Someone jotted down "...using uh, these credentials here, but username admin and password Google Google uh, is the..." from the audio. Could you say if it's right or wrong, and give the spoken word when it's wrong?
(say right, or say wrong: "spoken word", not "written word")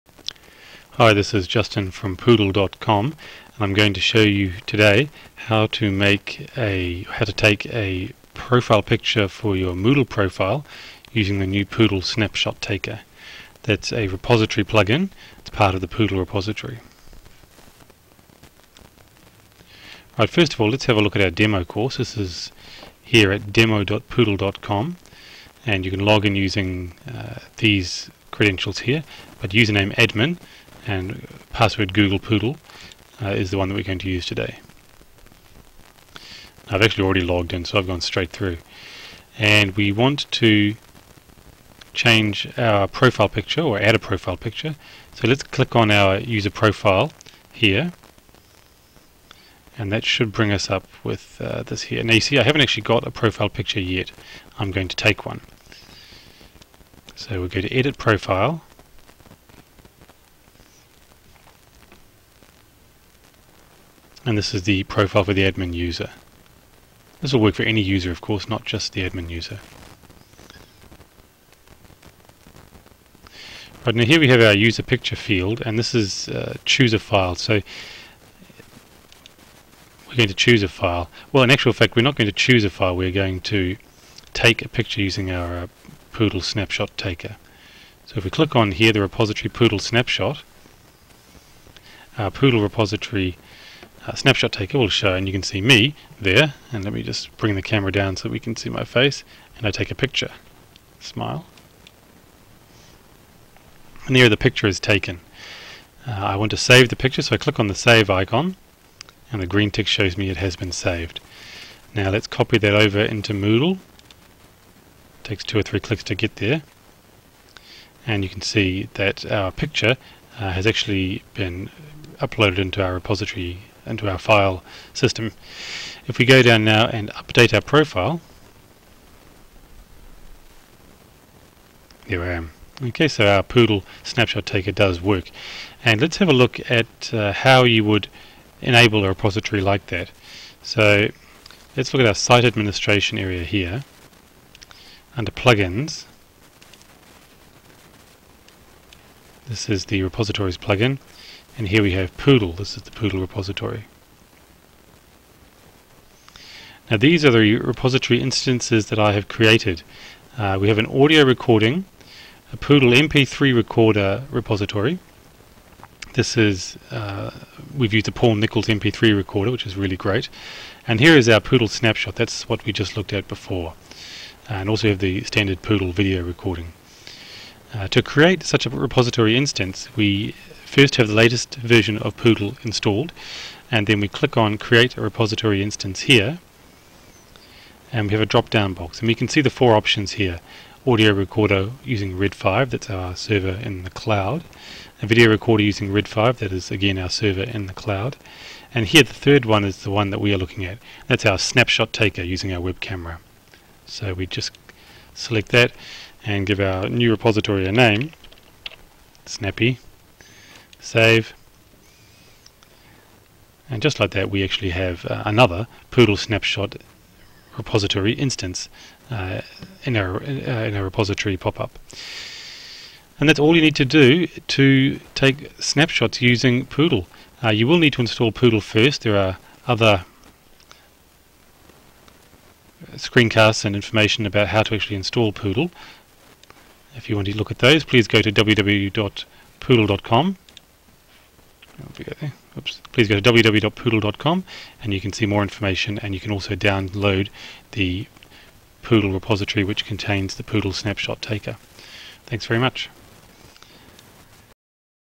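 wrong: "Poodle", not "Google".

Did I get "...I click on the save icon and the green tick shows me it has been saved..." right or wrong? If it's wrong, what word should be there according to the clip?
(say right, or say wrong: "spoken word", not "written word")
right.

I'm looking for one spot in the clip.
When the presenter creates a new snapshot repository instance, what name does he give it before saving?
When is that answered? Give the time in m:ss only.
3:29.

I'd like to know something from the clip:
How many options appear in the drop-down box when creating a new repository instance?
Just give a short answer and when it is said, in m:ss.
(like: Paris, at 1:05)
4, at 3:09.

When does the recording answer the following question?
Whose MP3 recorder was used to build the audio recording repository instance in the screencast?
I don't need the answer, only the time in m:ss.
2:48.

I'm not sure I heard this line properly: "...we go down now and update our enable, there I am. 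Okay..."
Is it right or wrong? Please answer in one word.
wrong.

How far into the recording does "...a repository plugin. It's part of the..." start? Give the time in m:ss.
0:13.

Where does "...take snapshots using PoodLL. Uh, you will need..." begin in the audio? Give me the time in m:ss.
3:45.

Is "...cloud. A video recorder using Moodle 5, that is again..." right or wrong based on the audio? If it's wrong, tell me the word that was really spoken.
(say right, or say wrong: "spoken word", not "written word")
wrong: "RED", not "Moodle".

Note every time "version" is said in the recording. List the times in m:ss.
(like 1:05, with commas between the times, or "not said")
3:01.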